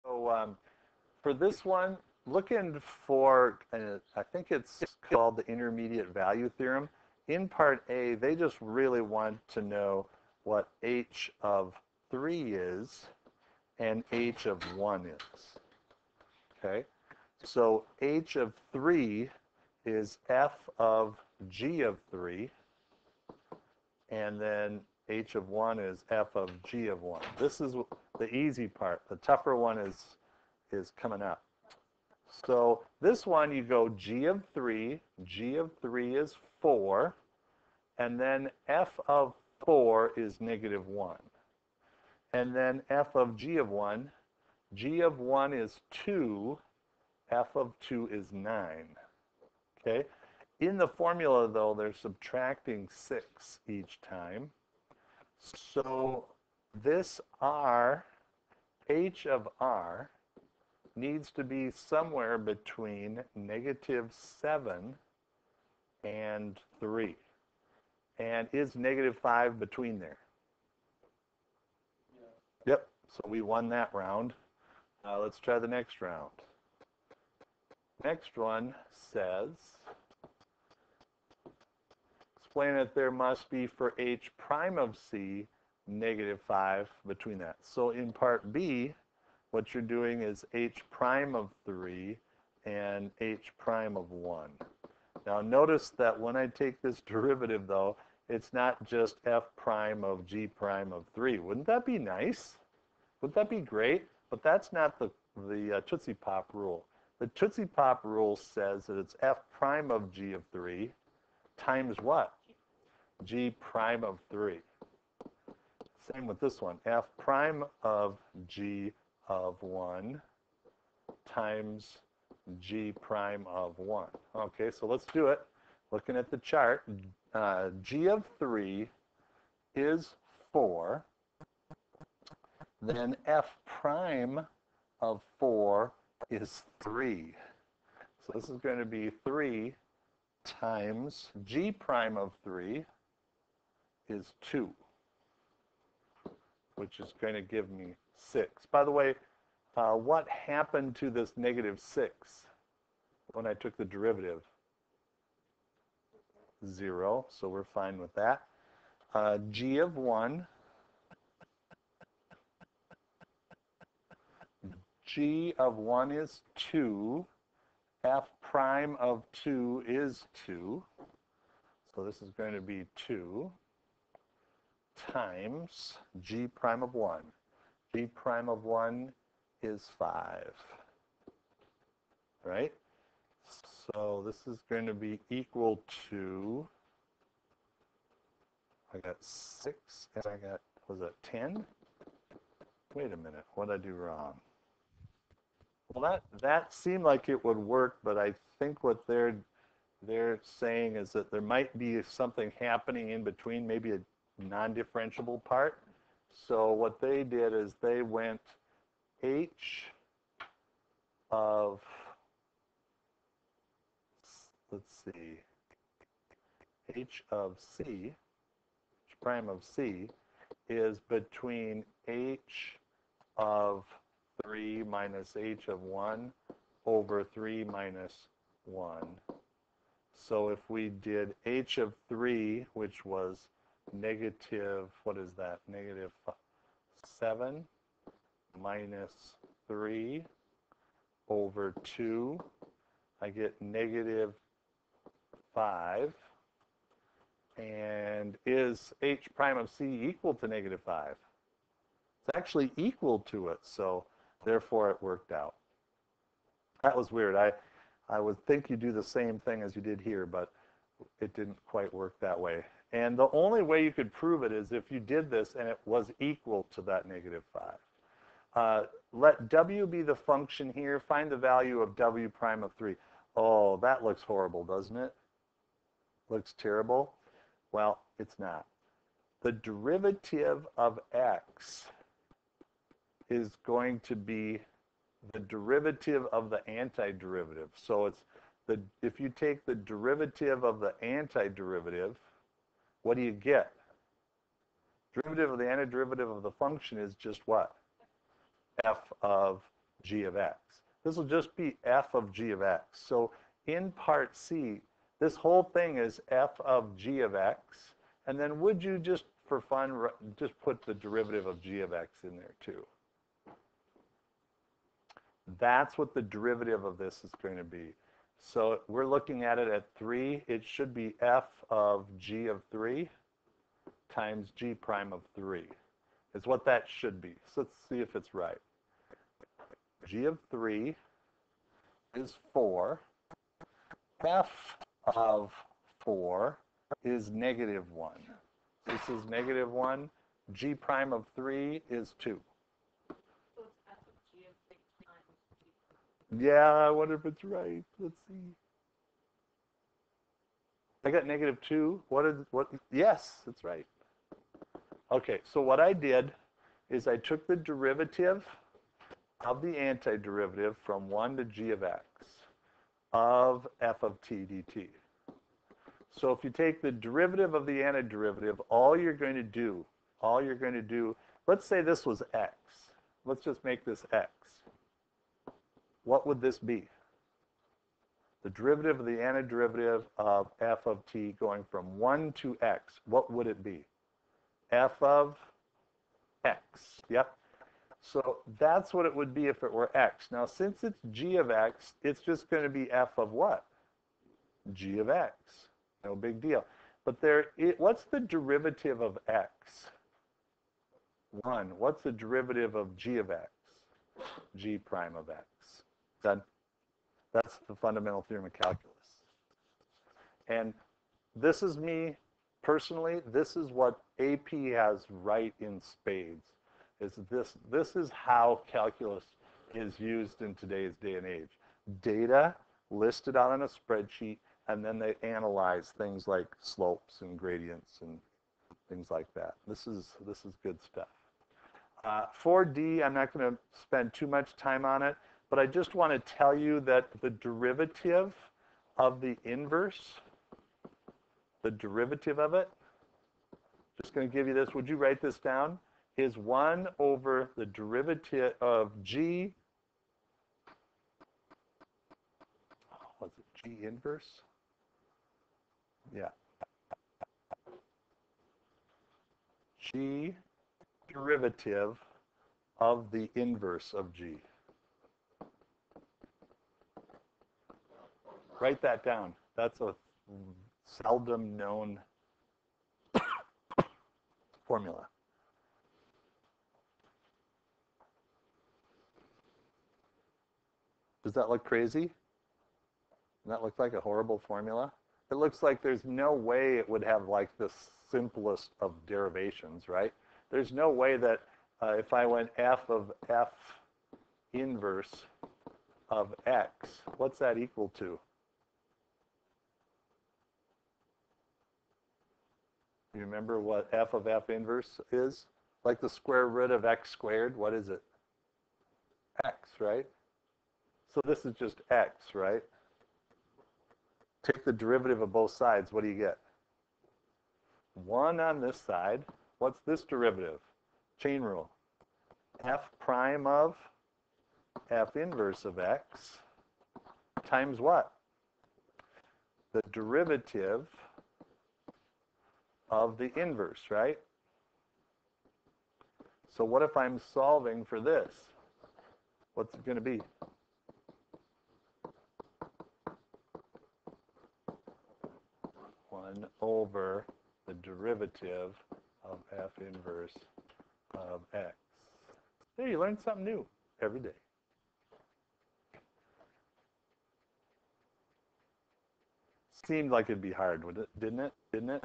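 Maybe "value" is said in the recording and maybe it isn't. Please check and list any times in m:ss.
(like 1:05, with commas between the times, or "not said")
0:06, 4:31.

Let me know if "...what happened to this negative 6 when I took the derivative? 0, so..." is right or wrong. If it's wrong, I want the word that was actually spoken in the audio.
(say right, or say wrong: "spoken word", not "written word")
right.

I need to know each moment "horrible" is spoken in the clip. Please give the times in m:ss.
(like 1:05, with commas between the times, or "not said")
4:34, 8:03.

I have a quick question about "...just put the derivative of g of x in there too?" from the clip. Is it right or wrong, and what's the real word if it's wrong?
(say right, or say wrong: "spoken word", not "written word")
right.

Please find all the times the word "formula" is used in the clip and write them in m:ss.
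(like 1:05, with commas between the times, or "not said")
0:50, 7:54, 8:04.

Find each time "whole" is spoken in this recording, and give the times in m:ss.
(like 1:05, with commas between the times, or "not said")
5:05.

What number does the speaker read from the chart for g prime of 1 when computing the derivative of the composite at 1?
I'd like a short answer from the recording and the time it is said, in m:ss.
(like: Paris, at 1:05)
5, at 2:56.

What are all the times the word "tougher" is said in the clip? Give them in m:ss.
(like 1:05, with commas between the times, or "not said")
0:29.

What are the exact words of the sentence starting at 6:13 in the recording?
Let's just make this x what would this be?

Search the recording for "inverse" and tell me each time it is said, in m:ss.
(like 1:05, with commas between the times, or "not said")
7:19, 7:33, 7:43, 8:14, 8:24, 8:45, 8:53, 9:09.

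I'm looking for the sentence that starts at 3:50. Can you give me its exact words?
So if we did H of 3, which was negative, what is that?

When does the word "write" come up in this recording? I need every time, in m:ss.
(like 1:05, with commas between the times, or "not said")
7:24, 7:48.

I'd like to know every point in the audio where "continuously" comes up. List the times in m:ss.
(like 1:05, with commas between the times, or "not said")
not said.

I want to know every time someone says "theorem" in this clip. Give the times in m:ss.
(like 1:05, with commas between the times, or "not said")
0:06, 6:48.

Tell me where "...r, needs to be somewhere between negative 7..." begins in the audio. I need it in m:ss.
0:59.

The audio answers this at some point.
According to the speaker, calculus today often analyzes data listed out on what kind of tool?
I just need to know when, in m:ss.
7:03.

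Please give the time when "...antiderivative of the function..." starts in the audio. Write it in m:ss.
4:55.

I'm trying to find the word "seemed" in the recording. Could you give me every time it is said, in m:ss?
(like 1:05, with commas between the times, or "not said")
3:16, 9:19.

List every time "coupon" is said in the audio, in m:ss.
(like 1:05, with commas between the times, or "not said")
not said.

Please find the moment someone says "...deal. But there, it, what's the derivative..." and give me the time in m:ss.
6:36.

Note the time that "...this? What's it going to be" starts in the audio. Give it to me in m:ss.
8:58.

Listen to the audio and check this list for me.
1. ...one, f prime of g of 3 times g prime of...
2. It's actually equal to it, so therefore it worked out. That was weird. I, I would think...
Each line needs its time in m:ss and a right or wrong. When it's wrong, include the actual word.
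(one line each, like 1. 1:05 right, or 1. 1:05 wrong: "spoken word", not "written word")
1. 1:56 wrong: "1", not "3"
2. 4:11 right.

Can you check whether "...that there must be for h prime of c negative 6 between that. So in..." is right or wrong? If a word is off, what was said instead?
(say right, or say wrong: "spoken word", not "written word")
wrong: "5", not "6".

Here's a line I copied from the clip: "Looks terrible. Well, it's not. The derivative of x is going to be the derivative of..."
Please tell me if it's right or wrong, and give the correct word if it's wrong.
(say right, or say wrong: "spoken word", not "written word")
right.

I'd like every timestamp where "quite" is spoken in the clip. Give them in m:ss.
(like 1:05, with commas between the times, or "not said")
4:21.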